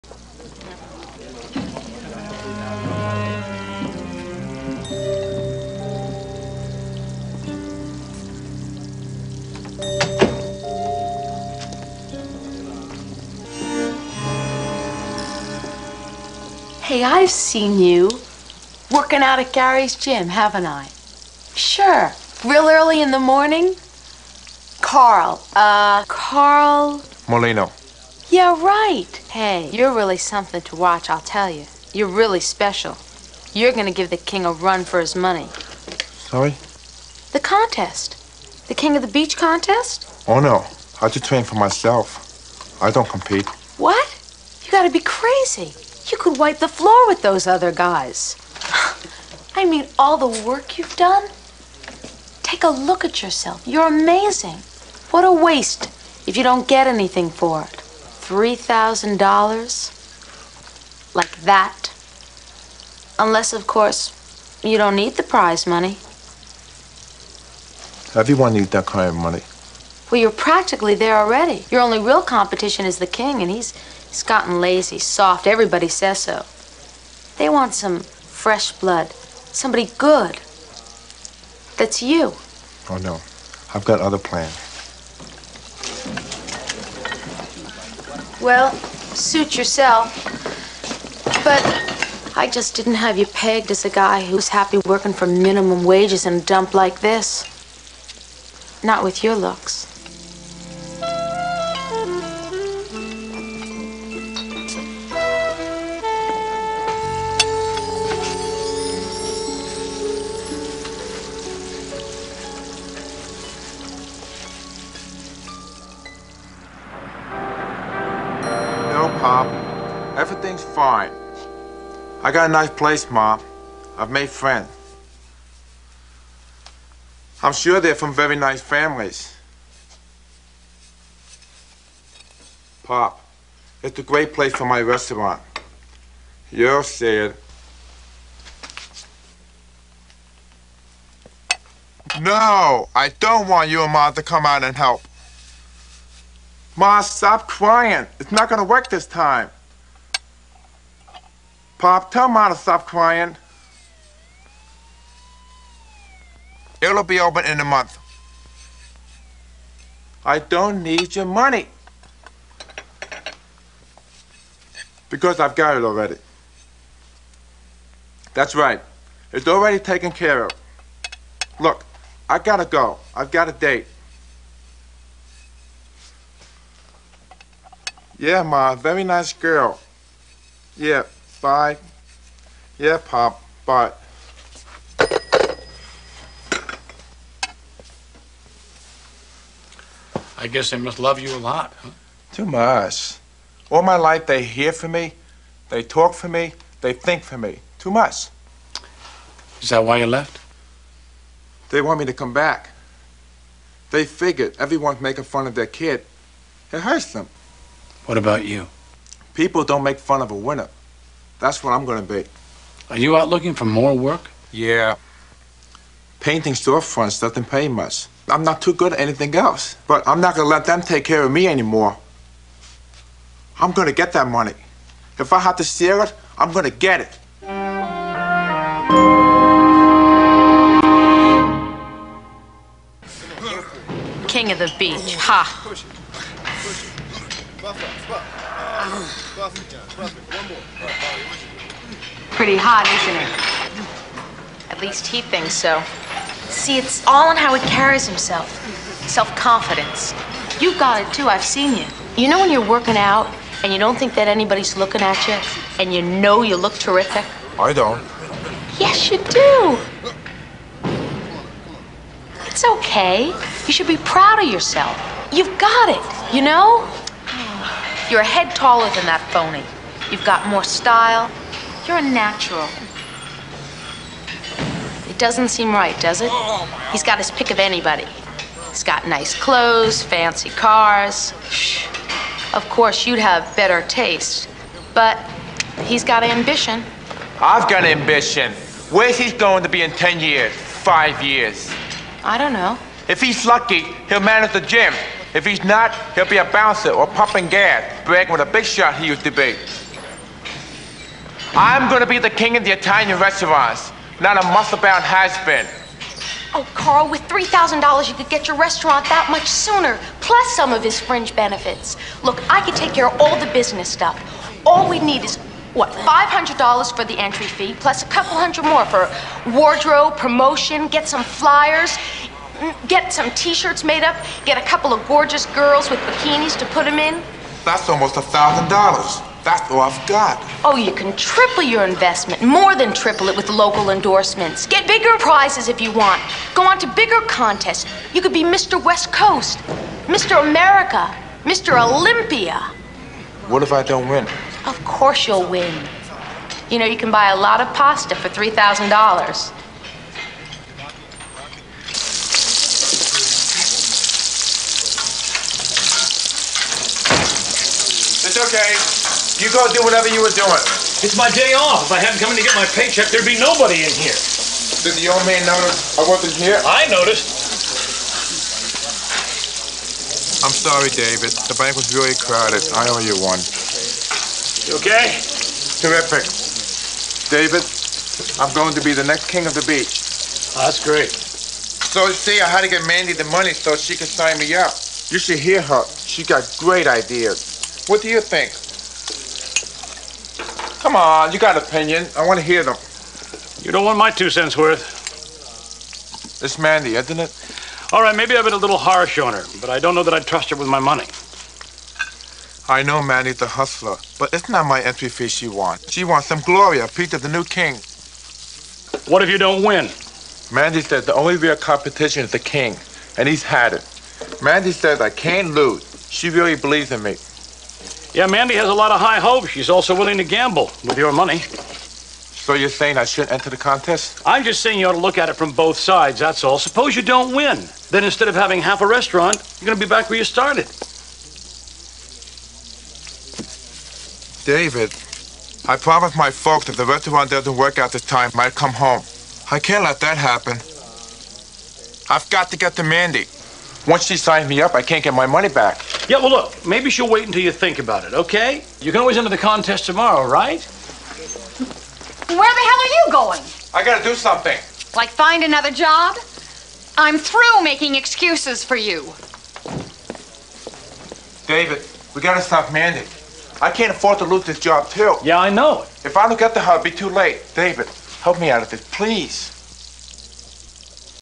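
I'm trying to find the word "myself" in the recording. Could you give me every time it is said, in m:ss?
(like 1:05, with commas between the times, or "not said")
0:41.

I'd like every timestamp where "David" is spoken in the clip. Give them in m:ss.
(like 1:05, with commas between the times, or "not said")
6:10, 6:17, 7:14, 7:41, 7:47.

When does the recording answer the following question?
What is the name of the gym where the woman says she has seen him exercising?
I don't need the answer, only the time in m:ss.
0:19.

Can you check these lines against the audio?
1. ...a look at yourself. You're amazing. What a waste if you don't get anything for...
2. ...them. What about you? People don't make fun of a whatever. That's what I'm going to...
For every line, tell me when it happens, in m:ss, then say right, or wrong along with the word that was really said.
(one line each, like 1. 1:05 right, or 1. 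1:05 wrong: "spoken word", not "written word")
1. 0:52 right
2. 3:27 wrong: "winner", not "whatever".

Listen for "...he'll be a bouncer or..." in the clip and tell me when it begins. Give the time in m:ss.
4:56.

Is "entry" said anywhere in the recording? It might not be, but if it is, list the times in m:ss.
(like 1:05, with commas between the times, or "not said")
5:17, 6:44.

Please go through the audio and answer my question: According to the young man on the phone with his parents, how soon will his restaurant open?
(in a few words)
In a month.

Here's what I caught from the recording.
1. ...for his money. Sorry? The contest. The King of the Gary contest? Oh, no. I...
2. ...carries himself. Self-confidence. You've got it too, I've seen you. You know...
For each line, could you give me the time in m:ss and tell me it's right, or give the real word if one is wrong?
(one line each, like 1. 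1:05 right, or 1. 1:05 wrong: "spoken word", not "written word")
1. 0:34 wrong: "Beach", not "Gary"
2. 4:07 right.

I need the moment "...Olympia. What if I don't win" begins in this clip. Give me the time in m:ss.
5:41.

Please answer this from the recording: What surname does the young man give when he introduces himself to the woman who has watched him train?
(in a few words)
Molino.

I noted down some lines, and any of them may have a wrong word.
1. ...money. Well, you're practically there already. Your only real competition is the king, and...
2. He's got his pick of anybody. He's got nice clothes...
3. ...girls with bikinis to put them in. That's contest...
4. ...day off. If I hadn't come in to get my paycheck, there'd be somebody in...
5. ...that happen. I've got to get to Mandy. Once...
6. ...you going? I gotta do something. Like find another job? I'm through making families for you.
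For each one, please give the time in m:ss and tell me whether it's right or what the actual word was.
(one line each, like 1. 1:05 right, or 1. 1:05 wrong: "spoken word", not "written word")
1. 1:09 right
2. 4:36 right
3. 5:25 wrong: "almost", not "contest"
4. 6:01 wrong: "nobody", not "somebody"
5. 7:20 right
6. 7:32 wrong: "excuses", not "families".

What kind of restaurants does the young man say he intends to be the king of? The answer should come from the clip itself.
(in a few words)
Italian restaurants.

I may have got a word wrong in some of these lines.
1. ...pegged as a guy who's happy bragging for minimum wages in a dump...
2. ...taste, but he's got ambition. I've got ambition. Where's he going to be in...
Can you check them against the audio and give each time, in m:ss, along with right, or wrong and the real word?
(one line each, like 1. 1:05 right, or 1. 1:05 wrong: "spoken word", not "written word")
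1. 1:33 wrong: "working", not "bragging"
2. 4:43 right.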